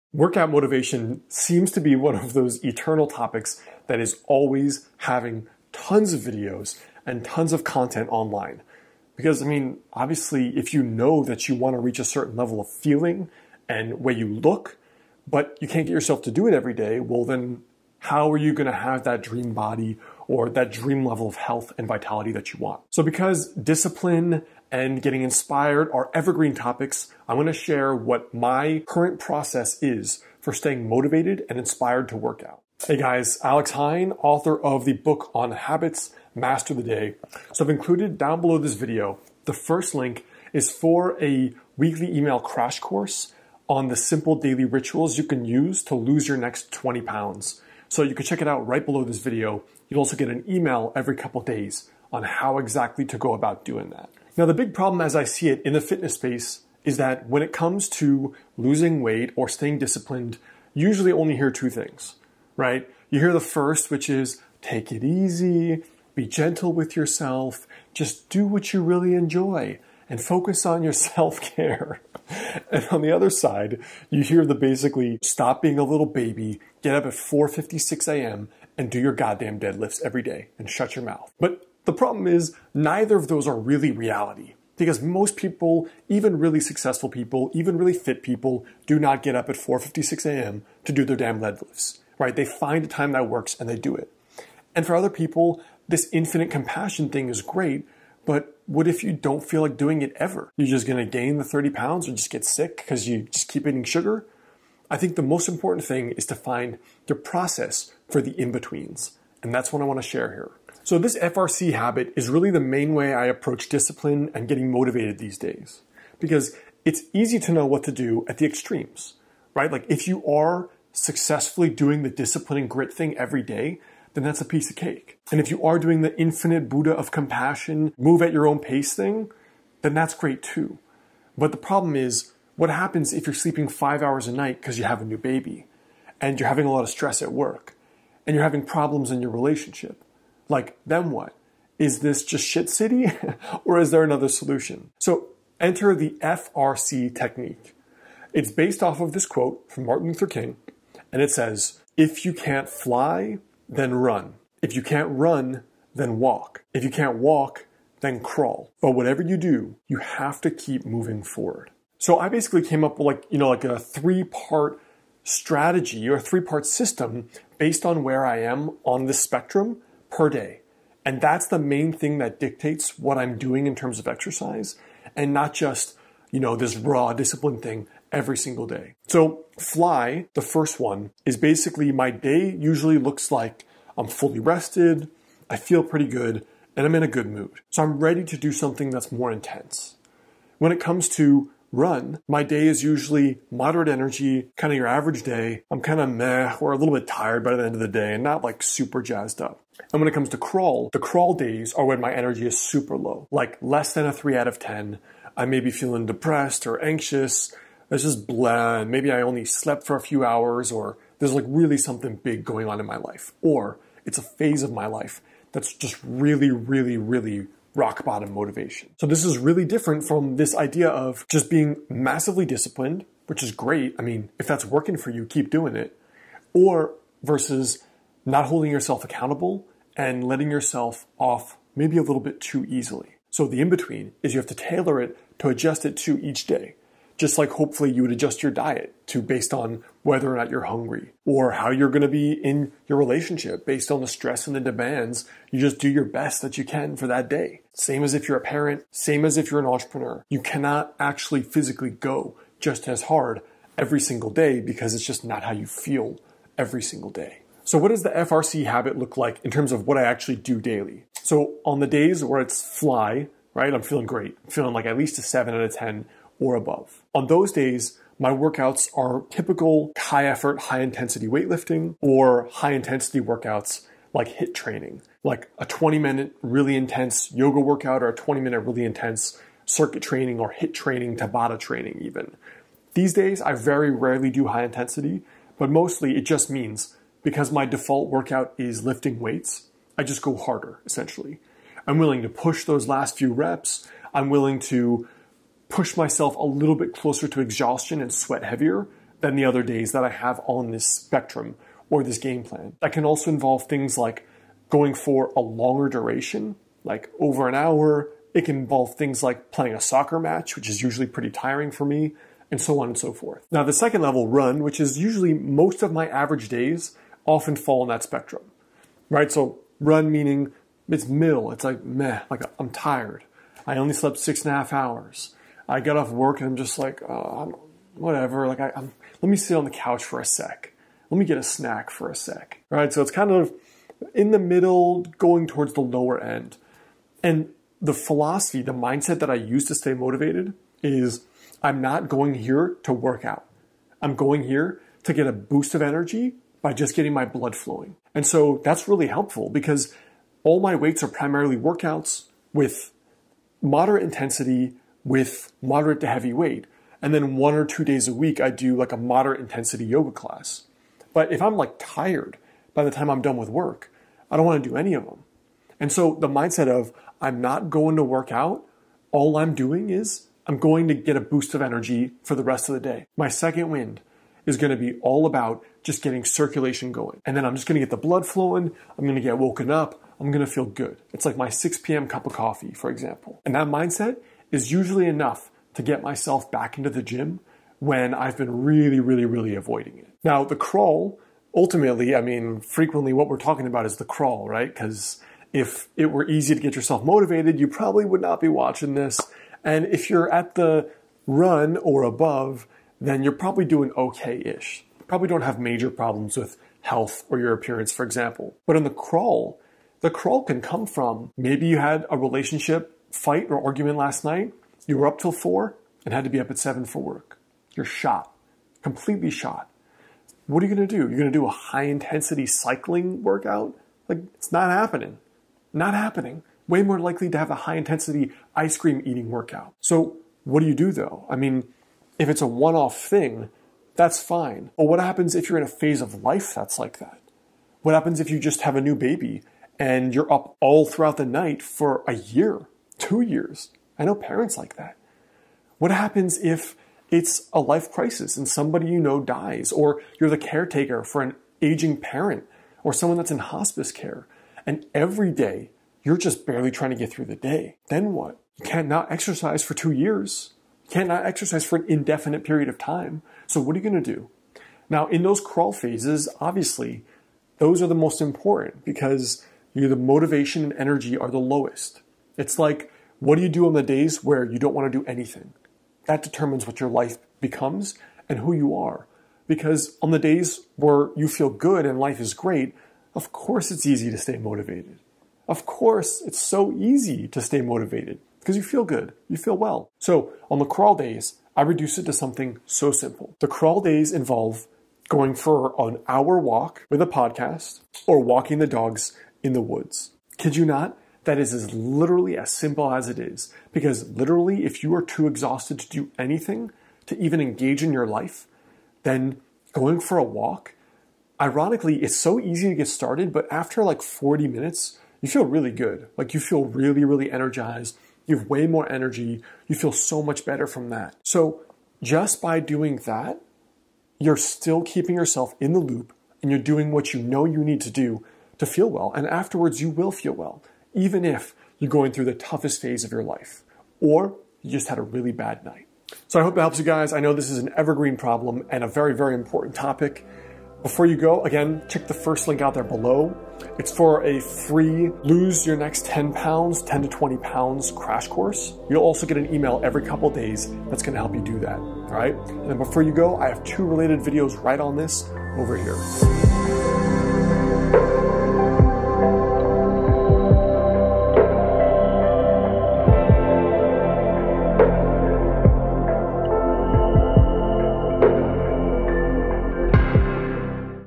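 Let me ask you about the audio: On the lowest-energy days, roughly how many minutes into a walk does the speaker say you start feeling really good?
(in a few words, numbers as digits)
40.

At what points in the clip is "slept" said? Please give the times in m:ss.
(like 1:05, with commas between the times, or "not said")
3:29, 5:23.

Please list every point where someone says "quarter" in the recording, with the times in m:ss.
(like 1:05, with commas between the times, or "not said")
not said.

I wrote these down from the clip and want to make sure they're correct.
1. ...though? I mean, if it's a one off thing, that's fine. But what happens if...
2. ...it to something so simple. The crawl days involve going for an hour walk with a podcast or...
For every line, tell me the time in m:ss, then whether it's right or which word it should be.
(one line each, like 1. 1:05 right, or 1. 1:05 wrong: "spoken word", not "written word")
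1. 7:10 right
2. 8:11 right.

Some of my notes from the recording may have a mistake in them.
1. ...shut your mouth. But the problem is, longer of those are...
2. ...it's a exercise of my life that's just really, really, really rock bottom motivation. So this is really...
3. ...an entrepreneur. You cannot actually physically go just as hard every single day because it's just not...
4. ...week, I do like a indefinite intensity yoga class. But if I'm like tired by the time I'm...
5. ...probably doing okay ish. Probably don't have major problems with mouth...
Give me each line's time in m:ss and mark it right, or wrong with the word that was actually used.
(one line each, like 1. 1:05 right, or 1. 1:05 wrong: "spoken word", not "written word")
1. 1:20 wrong: "neither", not "longer"
2. 3:34 wrong: "phase", not "exercise"
3. 4:09 right
4. 5:58 wrong: "moderate", not "indefinite"
5. 6:43 wrong: "health", not "mouth".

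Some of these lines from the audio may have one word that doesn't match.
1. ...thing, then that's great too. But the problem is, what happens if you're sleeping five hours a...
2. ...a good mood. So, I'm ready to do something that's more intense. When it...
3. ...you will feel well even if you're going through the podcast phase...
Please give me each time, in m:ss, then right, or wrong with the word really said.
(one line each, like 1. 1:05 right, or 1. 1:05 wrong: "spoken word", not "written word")
1. 2:08 right
2. 3:07 right
3. 8:49 wrong: "toughest", not "podcast".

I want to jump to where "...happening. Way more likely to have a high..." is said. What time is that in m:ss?
7:05.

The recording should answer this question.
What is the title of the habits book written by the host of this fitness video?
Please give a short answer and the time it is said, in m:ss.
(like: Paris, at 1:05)
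Master the Day, at 0:36.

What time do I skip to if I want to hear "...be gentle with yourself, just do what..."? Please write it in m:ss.
1:06.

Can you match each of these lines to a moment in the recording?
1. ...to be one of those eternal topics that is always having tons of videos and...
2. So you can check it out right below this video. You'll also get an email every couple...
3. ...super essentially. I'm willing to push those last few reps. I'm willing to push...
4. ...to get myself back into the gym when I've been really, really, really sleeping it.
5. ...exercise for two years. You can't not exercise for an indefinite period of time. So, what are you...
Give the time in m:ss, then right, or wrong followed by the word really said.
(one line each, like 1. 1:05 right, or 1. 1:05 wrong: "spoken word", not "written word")
1. 0:01 right
2. 0:47 right
3. 4:50 wrong: "harder", not "super"
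4. 6:25 wrong: "avoiding", not "sleeping"
5. 7:39 right.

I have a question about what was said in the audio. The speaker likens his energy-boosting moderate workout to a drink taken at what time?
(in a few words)
6 p.m.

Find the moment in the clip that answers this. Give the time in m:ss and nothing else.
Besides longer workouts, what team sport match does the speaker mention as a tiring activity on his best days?
5:09.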